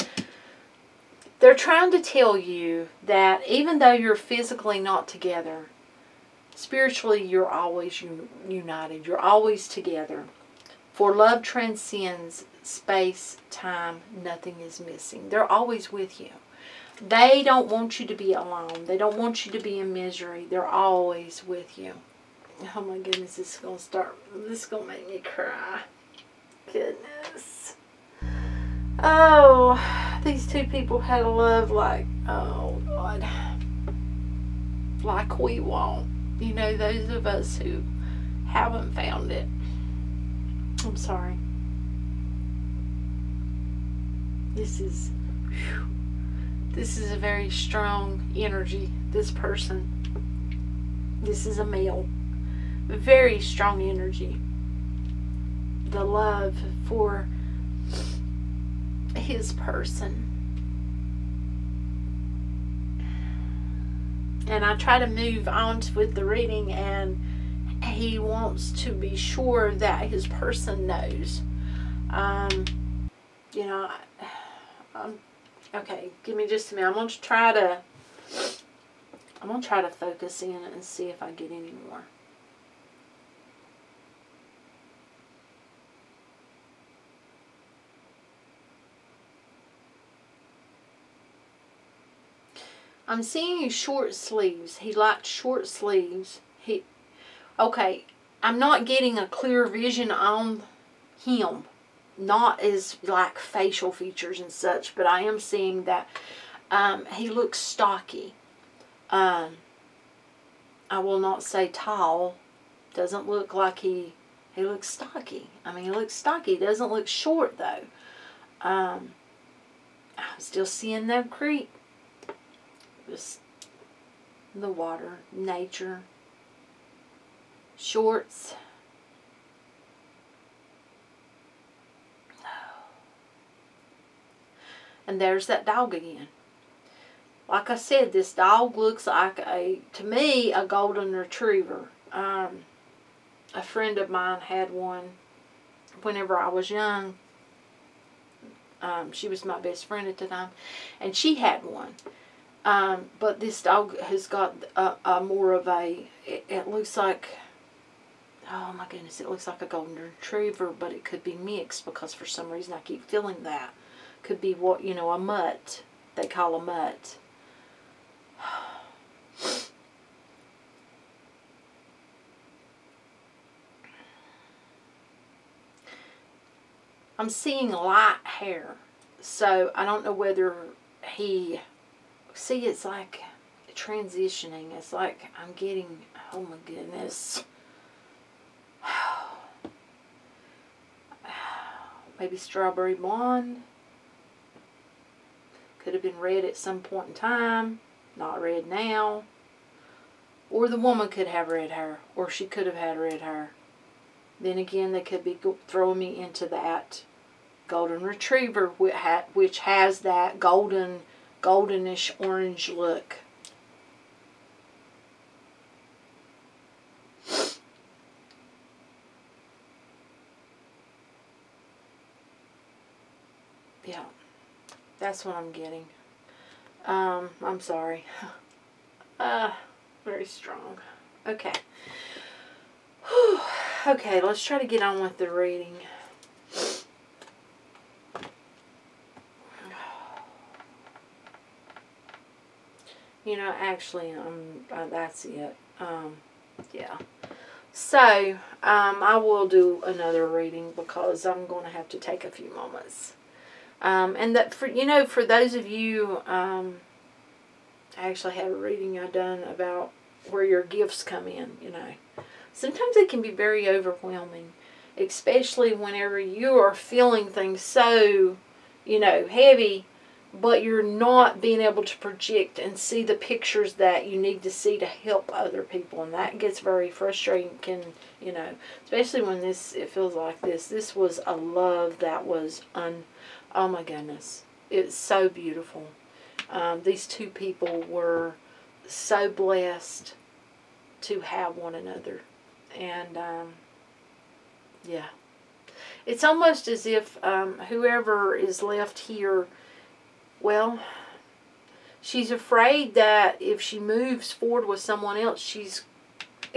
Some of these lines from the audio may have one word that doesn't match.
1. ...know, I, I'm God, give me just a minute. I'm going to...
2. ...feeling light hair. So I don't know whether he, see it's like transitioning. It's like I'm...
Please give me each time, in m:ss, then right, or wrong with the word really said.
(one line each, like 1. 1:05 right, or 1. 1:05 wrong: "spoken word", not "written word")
1. 1:13 wrong: "Okay", not "God"
2. 2:57 wrong: "seeing", not "feeling".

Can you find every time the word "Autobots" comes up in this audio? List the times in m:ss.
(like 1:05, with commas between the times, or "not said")
not said.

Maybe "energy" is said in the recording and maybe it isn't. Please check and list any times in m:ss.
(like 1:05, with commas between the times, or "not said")
0:48, 0:53.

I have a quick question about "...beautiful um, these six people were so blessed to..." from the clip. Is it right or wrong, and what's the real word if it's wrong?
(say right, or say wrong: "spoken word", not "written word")
wrong: "two", not "six".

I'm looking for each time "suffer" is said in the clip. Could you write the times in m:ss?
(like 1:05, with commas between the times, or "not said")
not said.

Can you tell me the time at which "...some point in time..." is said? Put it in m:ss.
3:16.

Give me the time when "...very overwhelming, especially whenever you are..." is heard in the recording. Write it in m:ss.
4:23.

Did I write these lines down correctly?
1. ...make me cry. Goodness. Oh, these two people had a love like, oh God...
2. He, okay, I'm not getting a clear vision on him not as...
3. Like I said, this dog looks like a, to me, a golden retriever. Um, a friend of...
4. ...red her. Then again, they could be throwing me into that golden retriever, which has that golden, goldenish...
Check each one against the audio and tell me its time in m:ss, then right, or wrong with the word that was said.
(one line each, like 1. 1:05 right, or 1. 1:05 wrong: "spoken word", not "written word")
1. 0:24 right
2. 1:36 right
3. 2:17 right
4. 3:22 right.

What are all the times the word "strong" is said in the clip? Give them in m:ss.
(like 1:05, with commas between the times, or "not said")
0:47, 0:53, 3:50.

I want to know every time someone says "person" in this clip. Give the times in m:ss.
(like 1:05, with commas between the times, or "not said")
0:49, 0:59, 1:10.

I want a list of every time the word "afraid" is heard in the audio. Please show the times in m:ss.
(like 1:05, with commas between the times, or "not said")
5:02.